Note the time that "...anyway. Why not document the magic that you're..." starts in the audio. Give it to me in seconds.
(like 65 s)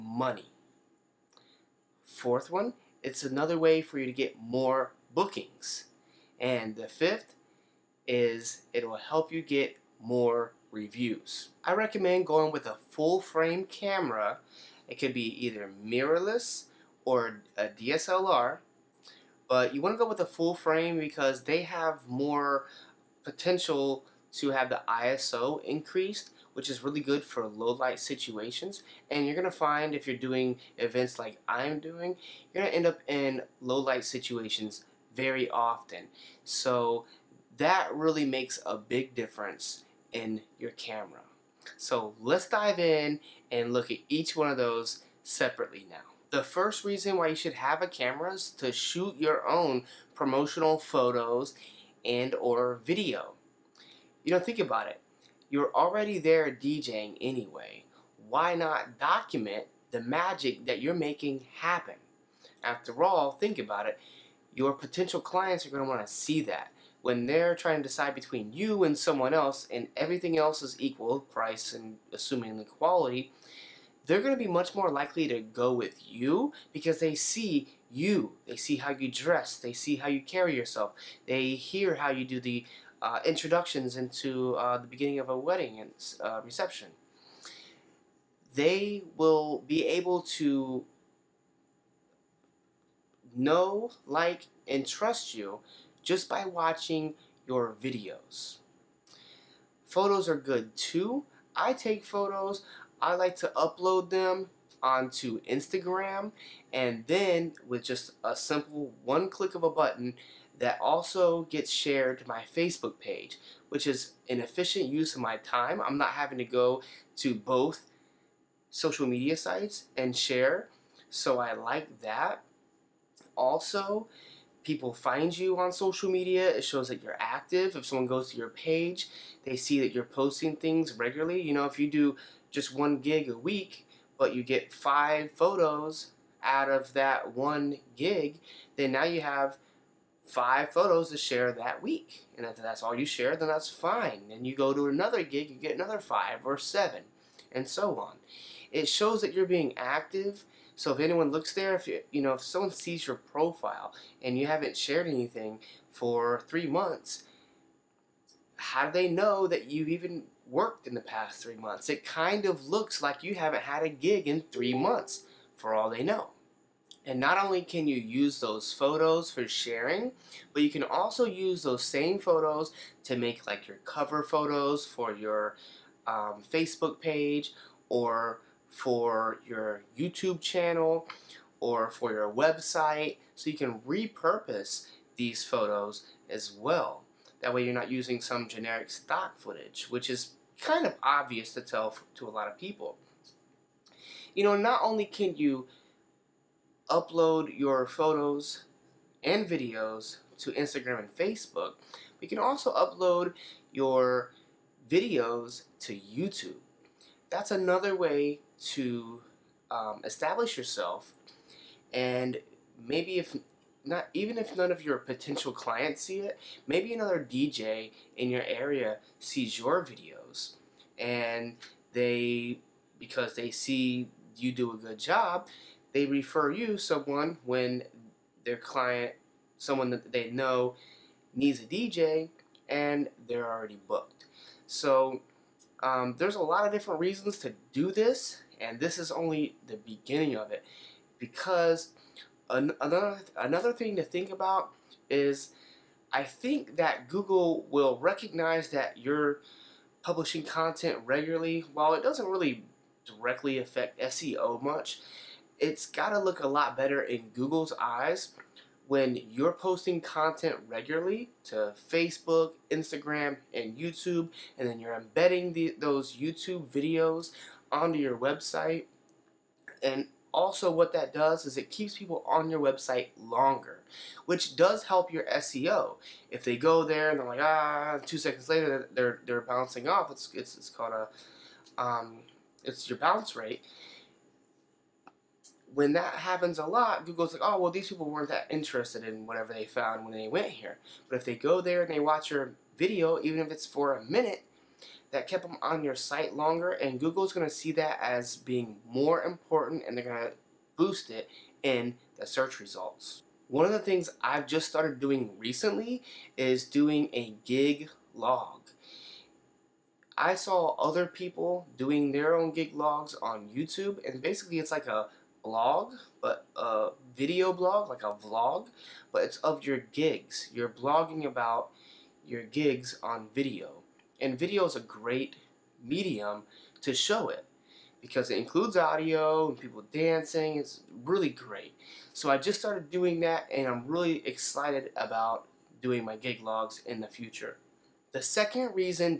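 57 s.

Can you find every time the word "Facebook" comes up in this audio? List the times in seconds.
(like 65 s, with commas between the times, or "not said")
112 s, 176 s, 201 s, 261 s.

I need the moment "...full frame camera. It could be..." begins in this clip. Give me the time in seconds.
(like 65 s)
12 s.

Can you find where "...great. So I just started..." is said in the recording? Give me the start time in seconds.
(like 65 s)
331 s.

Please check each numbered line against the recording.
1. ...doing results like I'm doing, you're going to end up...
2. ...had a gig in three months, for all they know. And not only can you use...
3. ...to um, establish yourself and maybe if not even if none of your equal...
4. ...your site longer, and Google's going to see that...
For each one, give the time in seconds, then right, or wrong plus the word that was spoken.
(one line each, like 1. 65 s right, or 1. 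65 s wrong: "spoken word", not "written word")
1. 30 s wrong: "events", not "results"
2. 163 s right
3. 208 s wrong: "potential", not "equal"
4. 295 s right.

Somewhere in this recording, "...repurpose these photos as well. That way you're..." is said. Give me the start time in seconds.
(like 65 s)
183 s.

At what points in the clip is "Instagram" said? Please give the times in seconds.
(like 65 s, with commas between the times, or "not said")
105 s, 200 s, 262 s.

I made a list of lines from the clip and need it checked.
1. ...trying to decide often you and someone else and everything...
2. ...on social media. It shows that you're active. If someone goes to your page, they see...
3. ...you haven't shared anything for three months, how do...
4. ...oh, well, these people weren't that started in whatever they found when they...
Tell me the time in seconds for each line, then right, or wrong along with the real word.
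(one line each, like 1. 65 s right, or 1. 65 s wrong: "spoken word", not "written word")
1. 67 s wrong: "between", not "often"
2. 125 s right
3. 154 s right
4. 287 s wrong: "interested", not "started".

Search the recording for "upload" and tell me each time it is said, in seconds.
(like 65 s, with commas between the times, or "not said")
103 s, 196 s, 202 s.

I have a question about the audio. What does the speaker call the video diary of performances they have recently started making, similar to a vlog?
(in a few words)
Gig log.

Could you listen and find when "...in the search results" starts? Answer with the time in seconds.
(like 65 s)
301 s.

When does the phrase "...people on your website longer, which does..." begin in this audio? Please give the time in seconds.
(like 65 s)
271 s.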